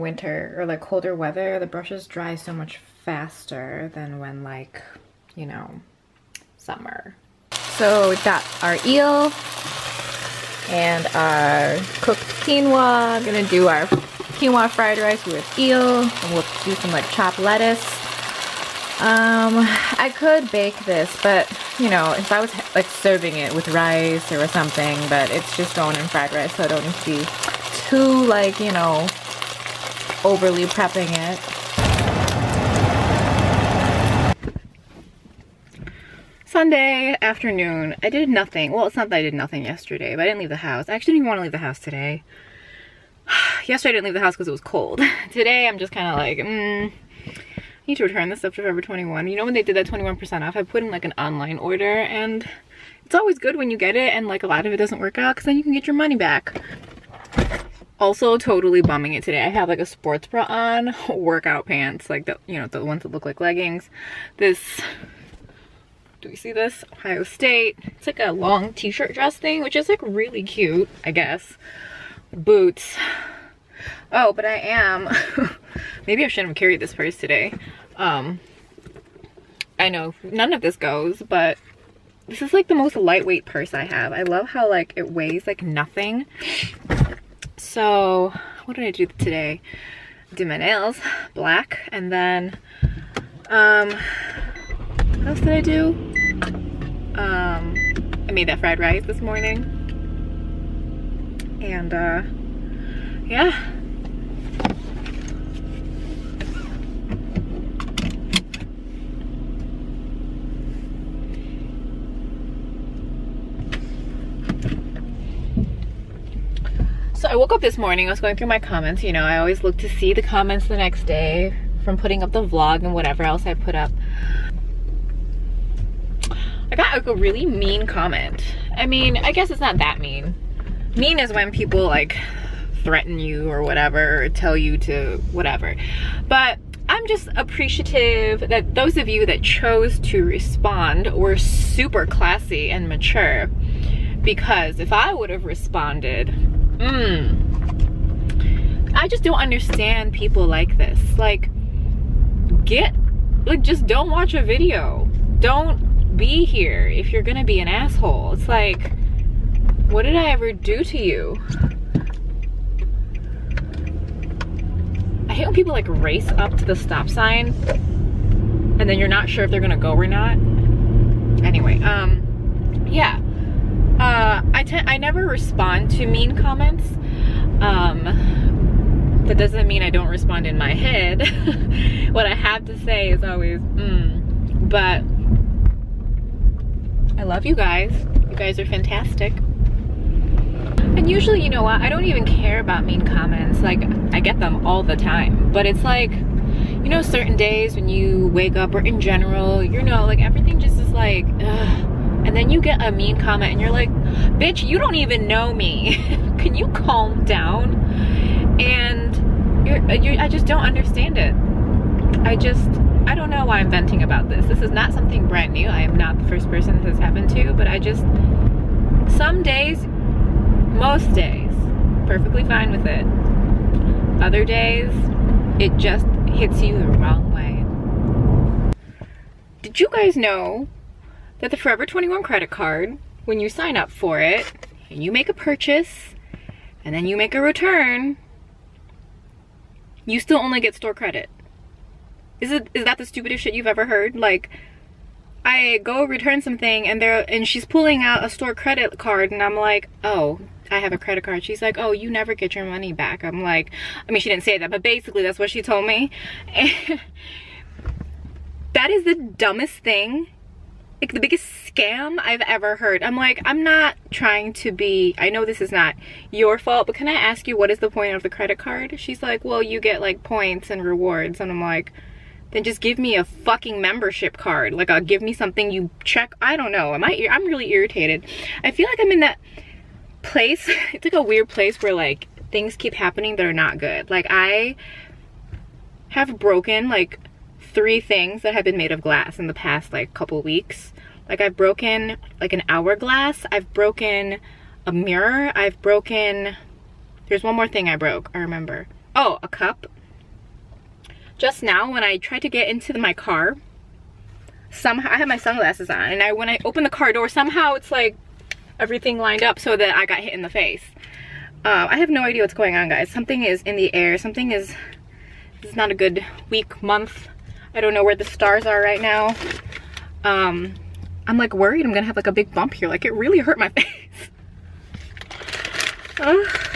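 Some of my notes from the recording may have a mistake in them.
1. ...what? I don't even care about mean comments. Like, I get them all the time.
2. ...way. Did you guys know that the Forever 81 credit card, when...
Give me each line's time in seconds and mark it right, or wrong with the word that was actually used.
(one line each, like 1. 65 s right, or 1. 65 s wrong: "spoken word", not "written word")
1. 191 s right
2. 227 s wrong: "21", not "81".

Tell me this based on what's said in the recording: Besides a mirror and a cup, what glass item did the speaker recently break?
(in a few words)
An hourglass.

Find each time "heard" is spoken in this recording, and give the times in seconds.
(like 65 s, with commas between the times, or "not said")
243 s, 262 s.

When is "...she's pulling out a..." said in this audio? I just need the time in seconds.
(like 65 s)
247 s.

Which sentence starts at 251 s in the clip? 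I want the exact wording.
She's like, oh, you never get your money back.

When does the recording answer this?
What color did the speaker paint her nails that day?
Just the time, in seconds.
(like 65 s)
91 s.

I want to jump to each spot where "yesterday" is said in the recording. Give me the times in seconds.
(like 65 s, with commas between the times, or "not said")
39 s, 43 s.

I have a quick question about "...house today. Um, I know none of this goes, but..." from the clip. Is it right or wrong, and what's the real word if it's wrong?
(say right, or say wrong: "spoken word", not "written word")
wrong: "purse", not "house".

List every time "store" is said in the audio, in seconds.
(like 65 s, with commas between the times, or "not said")
240 s, 248 s.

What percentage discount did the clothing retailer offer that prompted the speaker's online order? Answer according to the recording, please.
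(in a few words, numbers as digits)
21%.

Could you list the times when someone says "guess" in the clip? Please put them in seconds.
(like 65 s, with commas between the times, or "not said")
71 s, 129 s.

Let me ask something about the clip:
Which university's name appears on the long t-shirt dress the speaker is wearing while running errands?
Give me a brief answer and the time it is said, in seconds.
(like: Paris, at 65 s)
Ohio State, at 66 s.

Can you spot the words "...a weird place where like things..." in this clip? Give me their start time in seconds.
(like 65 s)
281 s.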